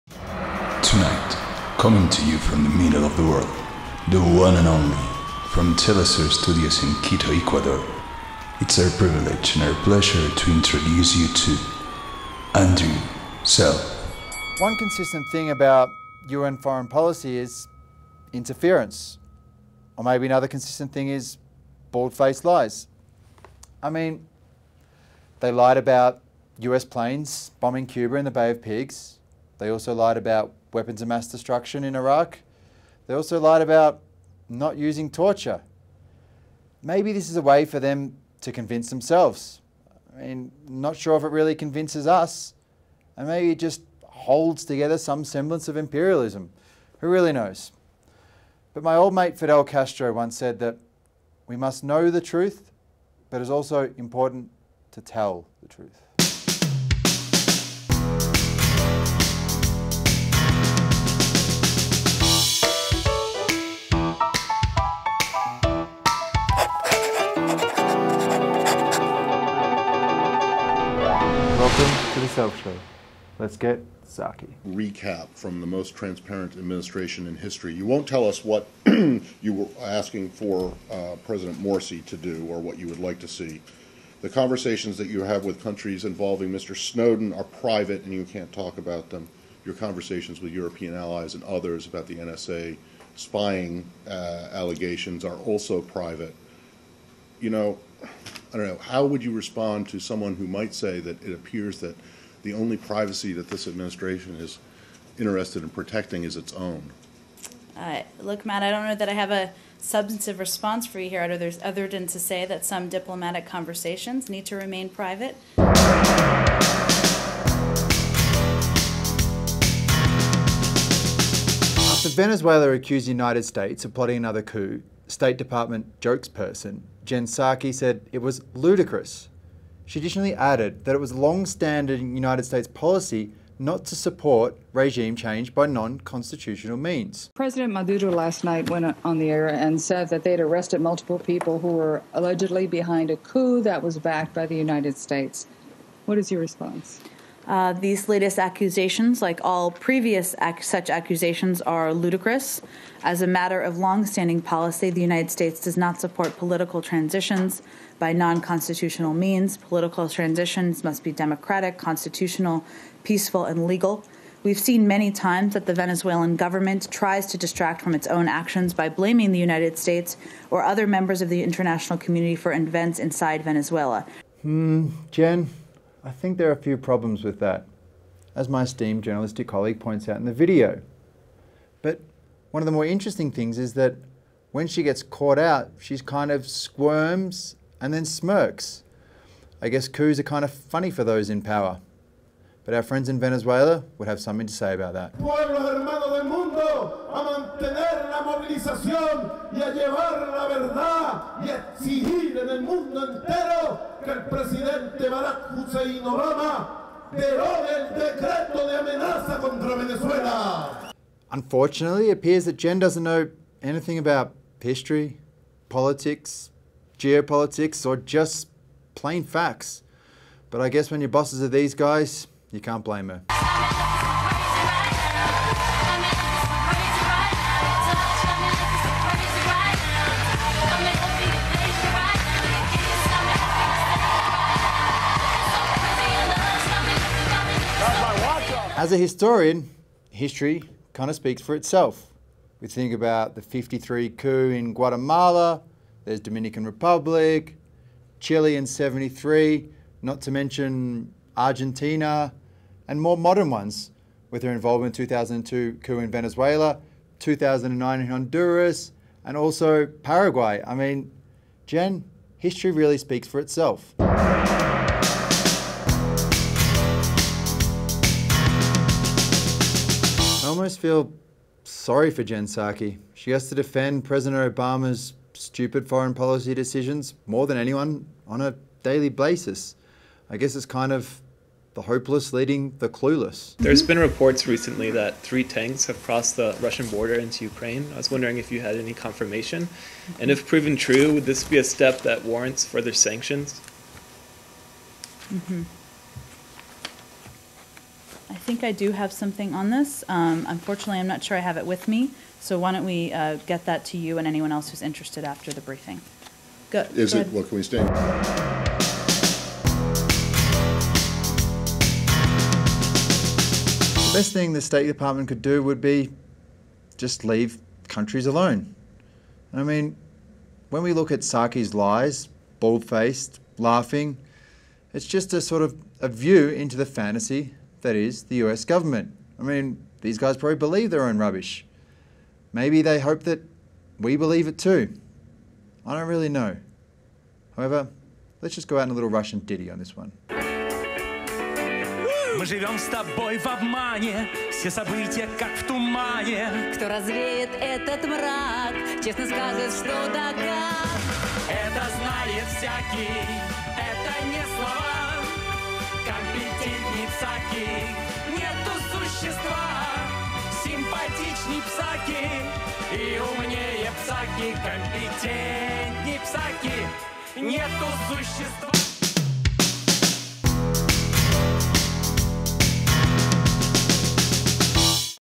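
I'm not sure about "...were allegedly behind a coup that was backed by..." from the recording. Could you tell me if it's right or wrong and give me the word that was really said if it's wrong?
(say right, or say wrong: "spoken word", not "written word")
right.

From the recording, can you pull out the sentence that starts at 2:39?
Political transitions must be democratic, constitutional, peaceful, and legal.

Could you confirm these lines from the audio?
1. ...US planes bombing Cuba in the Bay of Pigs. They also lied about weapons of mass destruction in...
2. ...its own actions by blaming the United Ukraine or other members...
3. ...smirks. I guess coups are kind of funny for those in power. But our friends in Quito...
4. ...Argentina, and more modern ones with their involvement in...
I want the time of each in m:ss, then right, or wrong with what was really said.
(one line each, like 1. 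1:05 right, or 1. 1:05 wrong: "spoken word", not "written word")
1. 0:26 right
2. 2:47 wrong: "States", not "Ukraine"
3. 3:08 wrong: "Venezuela", not "Quito"
4. 4:11 right.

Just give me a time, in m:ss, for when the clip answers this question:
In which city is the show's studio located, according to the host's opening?
0:07.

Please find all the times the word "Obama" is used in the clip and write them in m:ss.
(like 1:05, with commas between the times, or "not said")
3:26, 4:34.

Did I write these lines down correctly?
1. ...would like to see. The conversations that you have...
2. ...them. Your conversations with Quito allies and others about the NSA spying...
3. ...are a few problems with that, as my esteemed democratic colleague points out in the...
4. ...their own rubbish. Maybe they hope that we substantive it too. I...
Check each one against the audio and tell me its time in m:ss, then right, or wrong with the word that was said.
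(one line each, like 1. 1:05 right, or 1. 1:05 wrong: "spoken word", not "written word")
1. 1:22 right
2. 1:29 wrong: "European", not "Quito"
3. 2:56 wrong: "journalistic", not "democratic"
4. 5:30 wrong: "believe", not "substantive".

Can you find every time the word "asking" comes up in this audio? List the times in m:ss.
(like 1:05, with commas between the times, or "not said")
1:19.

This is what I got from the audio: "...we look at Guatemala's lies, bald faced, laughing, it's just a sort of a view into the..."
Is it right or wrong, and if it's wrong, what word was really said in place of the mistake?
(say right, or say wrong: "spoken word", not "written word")
wrong: "Psaki", not "Guatemala".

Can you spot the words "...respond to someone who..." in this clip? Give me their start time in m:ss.
1:39.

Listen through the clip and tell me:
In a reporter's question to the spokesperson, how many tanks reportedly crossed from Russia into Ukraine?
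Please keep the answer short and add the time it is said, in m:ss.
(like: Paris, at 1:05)
3, at 4:45.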